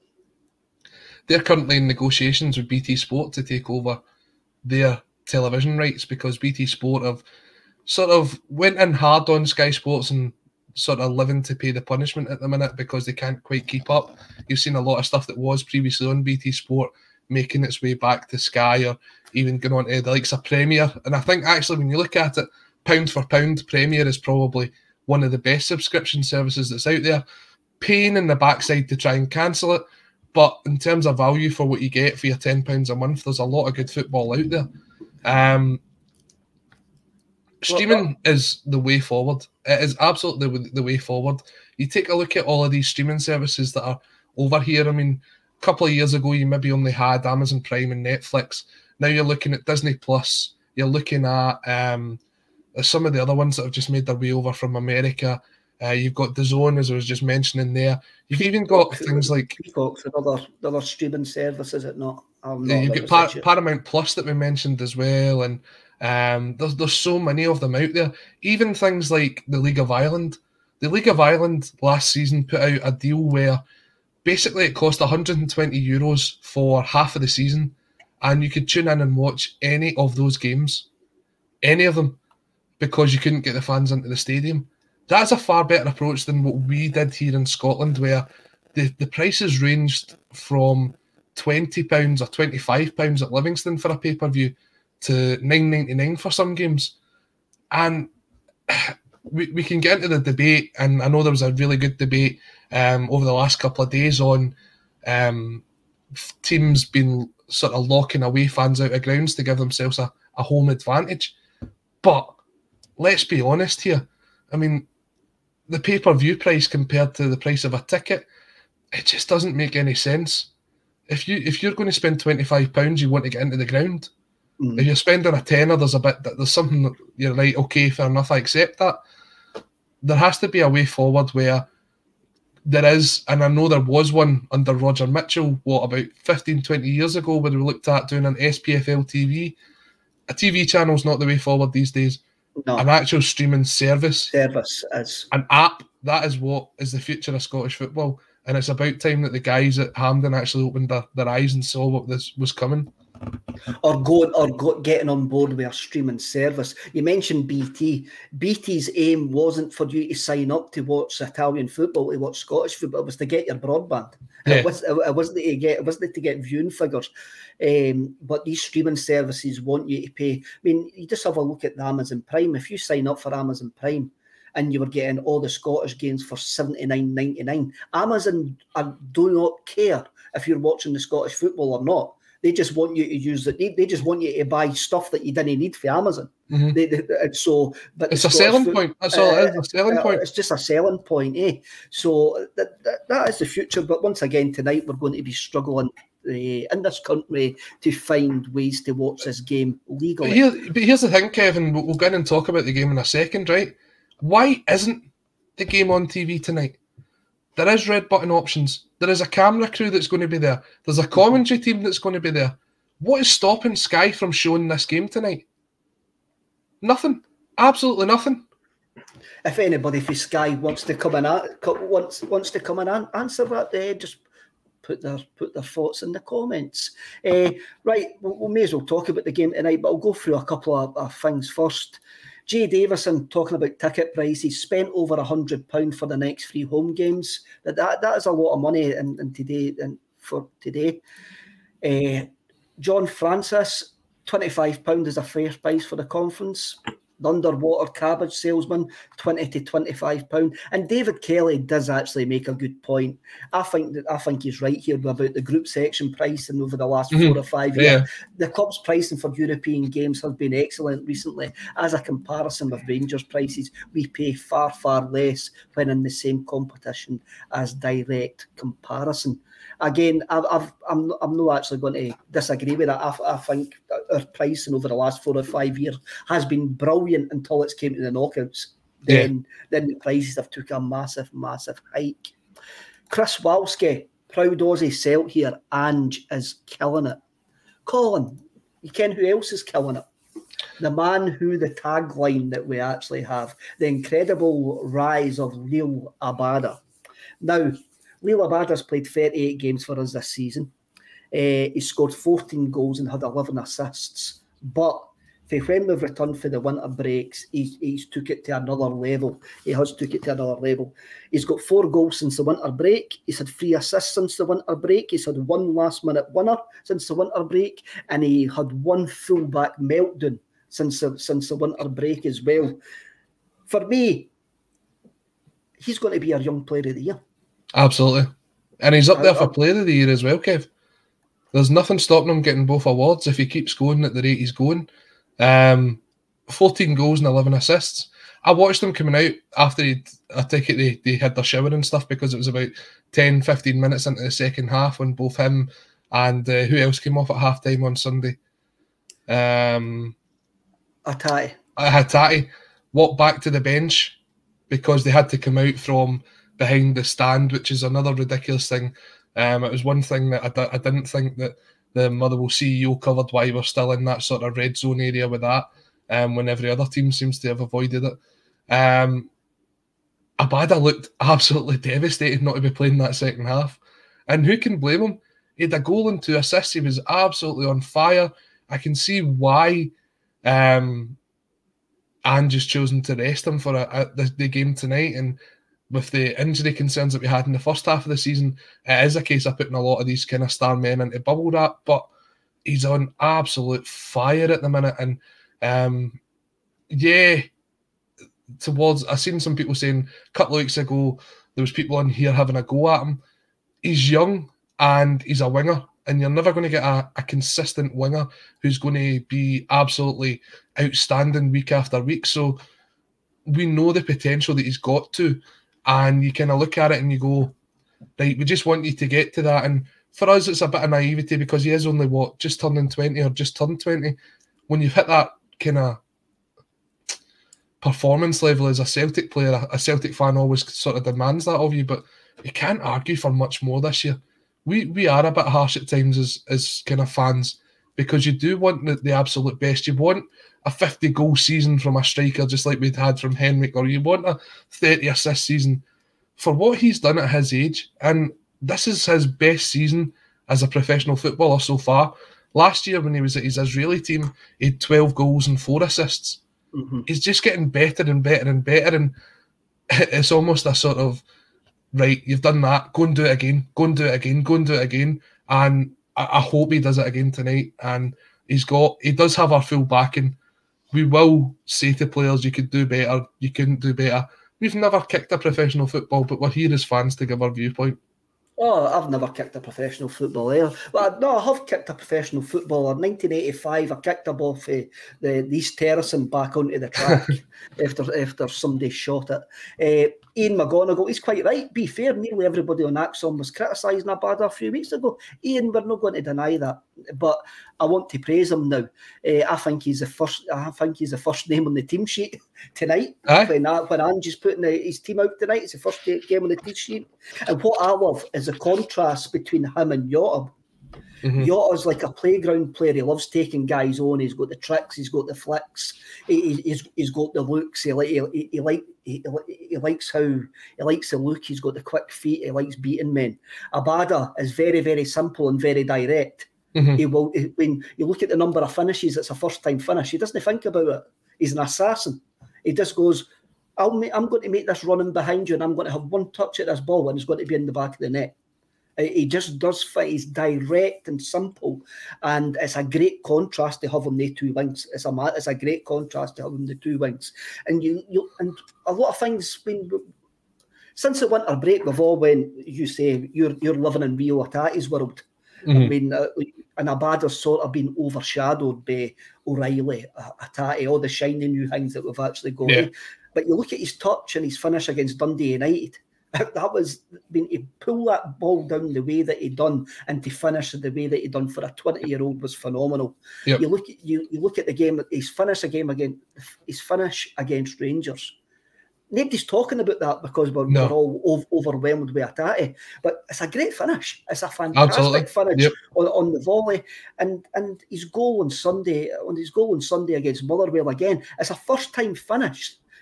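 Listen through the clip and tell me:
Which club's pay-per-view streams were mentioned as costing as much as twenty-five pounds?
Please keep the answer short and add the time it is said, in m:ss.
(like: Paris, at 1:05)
Livingston, at 1:33.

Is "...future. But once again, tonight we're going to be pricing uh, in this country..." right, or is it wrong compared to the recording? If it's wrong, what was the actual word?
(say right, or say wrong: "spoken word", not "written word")
wrong: "struggling", not "pricing".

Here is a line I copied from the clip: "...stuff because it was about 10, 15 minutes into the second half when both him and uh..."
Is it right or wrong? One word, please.
right.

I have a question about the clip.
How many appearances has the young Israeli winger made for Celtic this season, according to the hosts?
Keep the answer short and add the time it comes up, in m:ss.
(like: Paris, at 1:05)
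38, at 4:59.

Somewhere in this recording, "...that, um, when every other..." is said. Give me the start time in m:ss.
6:05.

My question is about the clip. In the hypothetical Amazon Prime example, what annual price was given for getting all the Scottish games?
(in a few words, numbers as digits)
79.99.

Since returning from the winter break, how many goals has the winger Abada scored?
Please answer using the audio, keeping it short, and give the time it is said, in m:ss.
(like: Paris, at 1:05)
4, at 5:11.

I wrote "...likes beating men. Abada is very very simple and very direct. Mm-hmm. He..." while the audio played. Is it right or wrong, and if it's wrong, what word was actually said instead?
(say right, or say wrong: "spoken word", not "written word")
right.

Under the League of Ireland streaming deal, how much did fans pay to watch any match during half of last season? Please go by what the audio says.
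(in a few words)
120 euros.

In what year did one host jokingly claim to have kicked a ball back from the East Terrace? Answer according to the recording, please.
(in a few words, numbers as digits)
1985.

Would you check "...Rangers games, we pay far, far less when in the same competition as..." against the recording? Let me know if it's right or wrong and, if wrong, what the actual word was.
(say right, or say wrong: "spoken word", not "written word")
wrong: "prices", not "games".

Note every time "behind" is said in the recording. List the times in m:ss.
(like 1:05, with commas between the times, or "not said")
5:56, 8:55.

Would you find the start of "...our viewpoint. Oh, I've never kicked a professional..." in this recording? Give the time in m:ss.
7:57.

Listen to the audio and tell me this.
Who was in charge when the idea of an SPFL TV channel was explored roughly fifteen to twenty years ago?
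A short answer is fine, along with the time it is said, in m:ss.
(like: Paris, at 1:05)
Roger Mitchell, at 2:14.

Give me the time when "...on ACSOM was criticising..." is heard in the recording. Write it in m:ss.
8:12.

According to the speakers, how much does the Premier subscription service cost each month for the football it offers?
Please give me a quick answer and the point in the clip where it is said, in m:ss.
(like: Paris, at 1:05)
£10, at 0:32.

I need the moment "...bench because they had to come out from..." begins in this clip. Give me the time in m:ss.
5:53.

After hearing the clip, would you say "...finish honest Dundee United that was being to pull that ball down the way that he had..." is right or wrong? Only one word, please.
wrong.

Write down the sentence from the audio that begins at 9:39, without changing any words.
Nobody's talking about that because we're, no.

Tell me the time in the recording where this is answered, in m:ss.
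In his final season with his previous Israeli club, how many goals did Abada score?
7:34.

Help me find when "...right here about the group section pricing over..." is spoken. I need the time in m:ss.
4:14.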